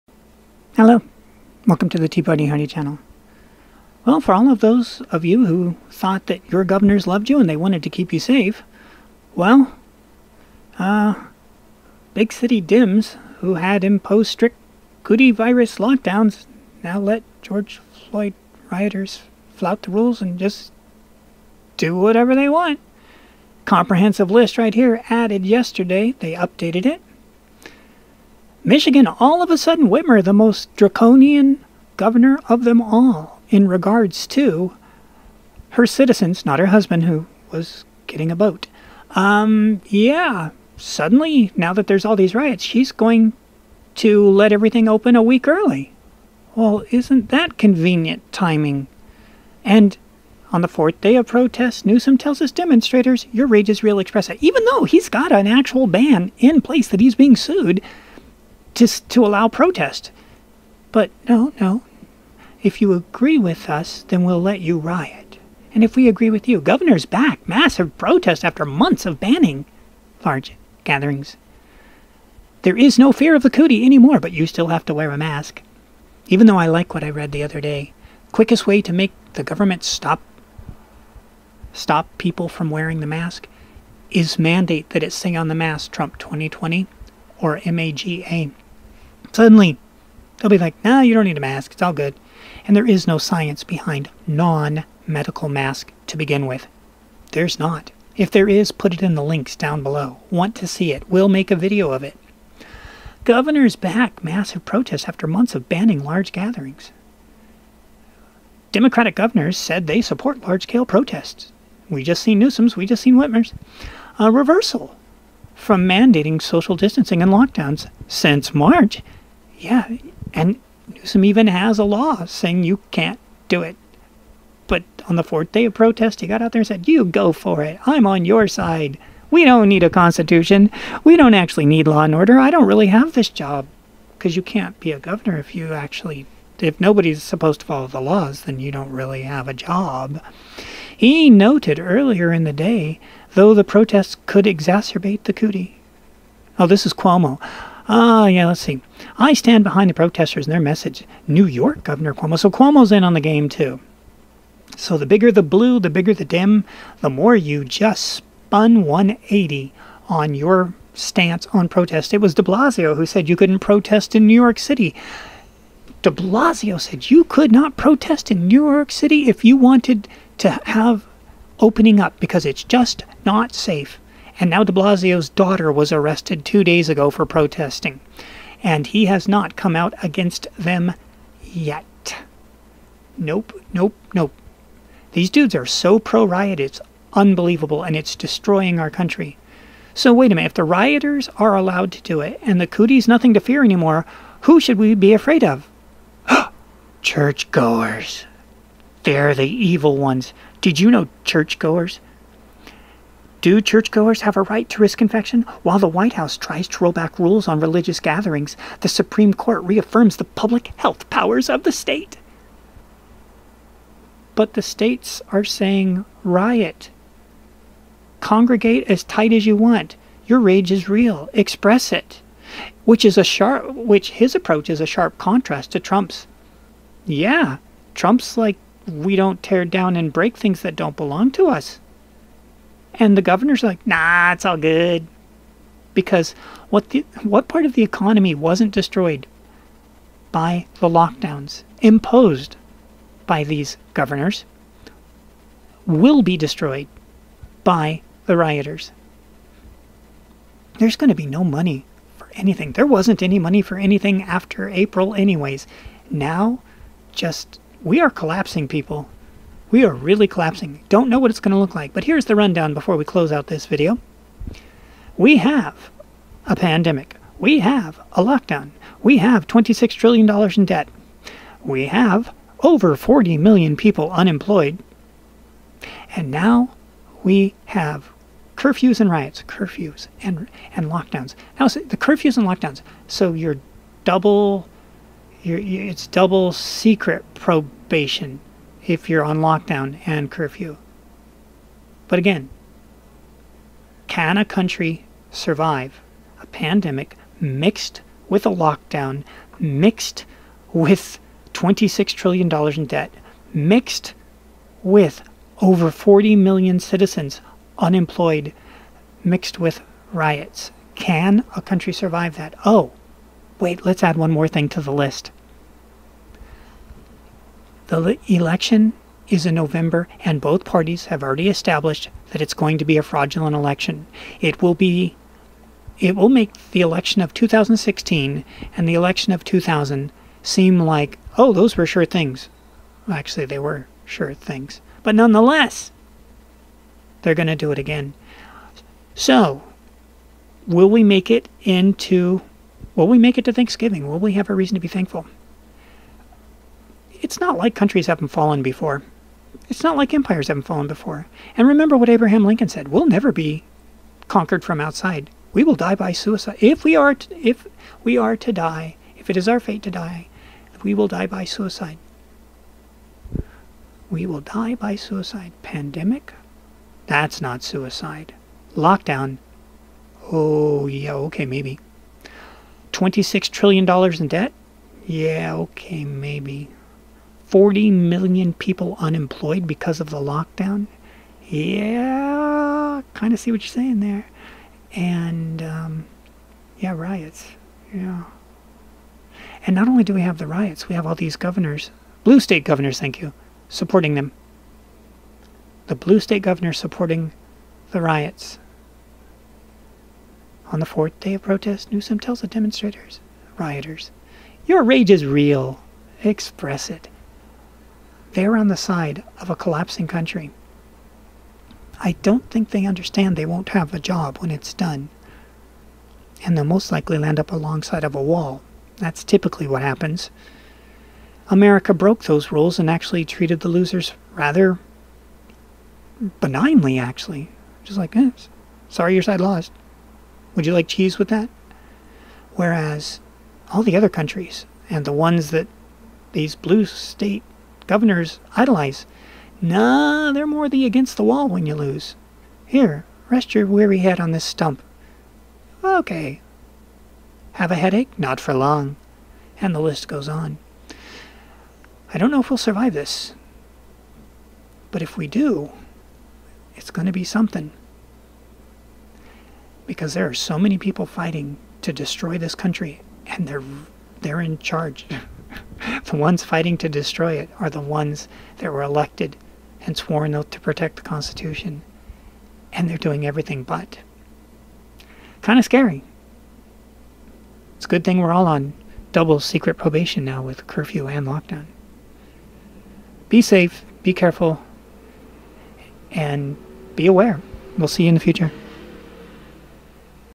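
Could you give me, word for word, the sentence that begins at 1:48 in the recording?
Democratic governors said they support large scale protests.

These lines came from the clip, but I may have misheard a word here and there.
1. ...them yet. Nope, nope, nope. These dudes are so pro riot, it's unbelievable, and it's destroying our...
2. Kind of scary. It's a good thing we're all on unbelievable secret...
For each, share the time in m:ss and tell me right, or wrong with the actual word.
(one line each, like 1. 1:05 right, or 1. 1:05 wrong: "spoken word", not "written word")
1. 3:00 right
2. 7:55 wrong: "double", not "unbelievable".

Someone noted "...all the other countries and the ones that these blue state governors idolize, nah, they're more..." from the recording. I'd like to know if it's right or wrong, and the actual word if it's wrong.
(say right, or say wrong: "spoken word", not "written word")
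right.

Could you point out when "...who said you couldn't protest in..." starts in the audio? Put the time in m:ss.
2:42.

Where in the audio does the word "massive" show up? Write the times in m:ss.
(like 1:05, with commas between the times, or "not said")
1:07, 1:44.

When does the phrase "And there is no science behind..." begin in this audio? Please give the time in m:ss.
1:32.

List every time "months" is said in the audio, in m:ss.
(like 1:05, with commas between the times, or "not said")
1:08, 1:45.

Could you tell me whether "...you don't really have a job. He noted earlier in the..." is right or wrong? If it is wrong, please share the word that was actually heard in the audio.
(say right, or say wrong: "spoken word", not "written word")
right.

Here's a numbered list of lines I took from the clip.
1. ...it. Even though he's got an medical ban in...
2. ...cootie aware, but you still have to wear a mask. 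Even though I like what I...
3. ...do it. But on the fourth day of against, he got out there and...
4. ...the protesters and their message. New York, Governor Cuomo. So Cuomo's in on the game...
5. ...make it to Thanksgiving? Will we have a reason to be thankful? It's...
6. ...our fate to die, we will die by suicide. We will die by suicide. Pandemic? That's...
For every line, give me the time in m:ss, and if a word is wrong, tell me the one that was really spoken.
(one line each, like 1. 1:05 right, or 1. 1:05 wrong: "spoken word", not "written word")
1. 0:54 wrong: "actual", not "medical"
2. 1:13 wrong: "anymore", not "aware"
3. 2:03 wrong: "protest", not "against"
4. 2:29 right
5. 5:43 right
6. 5:59 right.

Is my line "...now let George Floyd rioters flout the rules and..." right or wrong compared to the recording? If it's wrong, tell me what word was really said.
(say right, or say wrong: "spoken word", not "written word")
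right.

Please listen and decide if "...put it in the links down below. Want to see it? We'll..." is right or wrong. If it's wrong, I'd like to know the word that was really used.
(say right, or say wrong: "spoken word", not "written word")
right.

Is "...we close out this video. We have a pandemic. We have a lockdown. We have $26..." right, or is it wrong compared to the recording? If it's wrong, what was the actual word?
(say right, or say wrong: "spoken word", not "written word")
right.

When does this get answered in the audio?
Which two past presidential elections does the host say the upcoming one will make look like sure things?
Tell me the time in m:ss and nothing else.
5:27.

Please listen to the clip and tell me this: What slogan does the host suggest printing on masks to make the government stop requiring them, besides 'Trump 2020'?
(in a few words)
MAGA.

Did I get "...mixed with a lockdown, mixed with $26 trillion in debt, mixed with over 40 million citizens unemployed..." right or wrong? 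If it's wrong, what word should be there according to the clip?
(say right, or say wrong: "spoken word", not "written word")
right.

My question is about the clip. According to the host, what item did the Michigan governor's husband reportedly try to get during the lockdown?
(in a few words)
a boat.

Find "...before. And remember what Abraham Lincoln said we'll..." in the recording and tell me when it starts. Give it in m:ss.
5:50.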